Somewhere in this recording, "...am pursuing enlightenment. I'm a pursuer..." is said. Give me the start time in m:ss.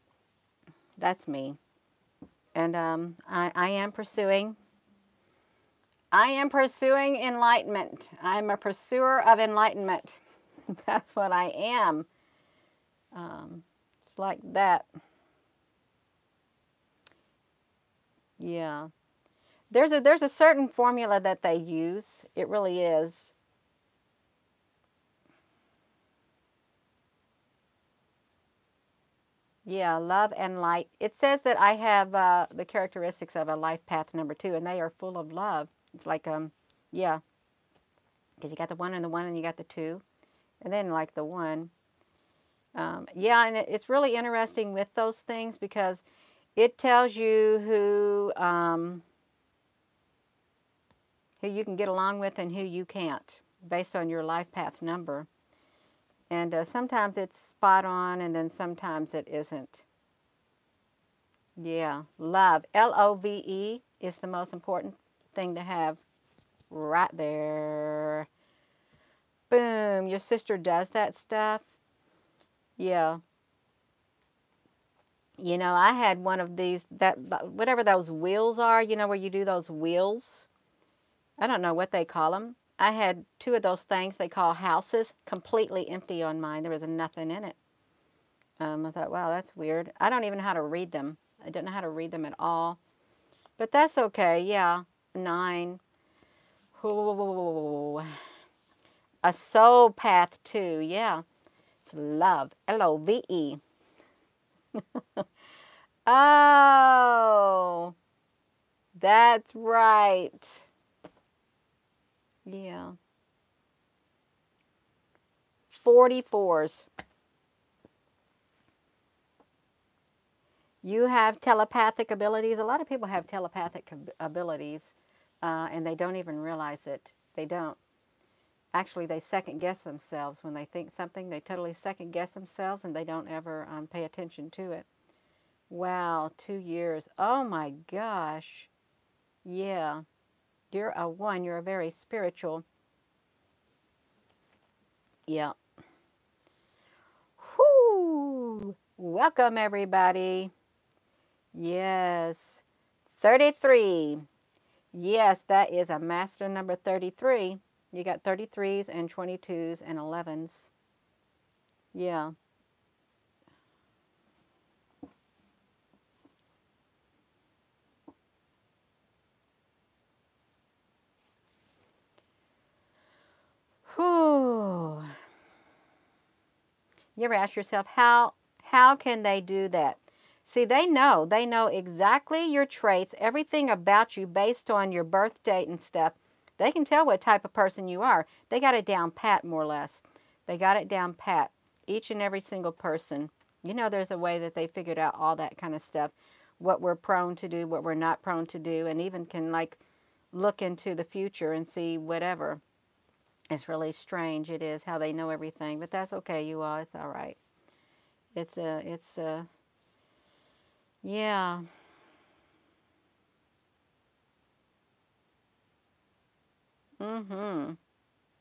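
0:06.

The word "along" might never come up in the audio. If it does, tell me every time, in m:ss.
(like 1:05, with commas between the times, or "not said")
0:51.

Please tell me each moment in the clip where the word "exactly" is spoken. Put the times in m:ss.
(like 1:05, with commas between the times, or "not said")
3:01.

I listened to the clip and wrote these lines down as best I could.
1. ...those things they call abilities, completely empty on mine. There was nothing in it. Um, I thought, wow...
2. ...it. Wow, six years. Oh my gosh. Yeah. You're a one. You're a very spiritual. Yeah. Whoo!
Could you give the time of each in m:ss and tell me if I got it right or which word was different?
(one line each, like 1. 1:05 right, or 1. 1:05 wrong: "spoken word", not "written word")
1. 1:23 wrong: "houses", not "abilities"
2. 2:14 wrong: "two", not "six".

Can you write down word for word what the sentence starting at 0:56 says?
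And uh, sometimes it's spot on and then sometimes it isn't.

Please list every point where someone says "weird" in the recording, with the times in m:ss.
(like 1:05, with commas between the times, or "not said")
1:29.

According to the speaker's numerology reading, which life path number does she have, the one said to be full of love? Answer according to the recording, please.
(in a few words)
2.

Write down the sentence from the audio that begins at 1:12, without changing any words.
Yeah, you know, I had one of these, that whatever those wheels are, you know, where you do those wheels.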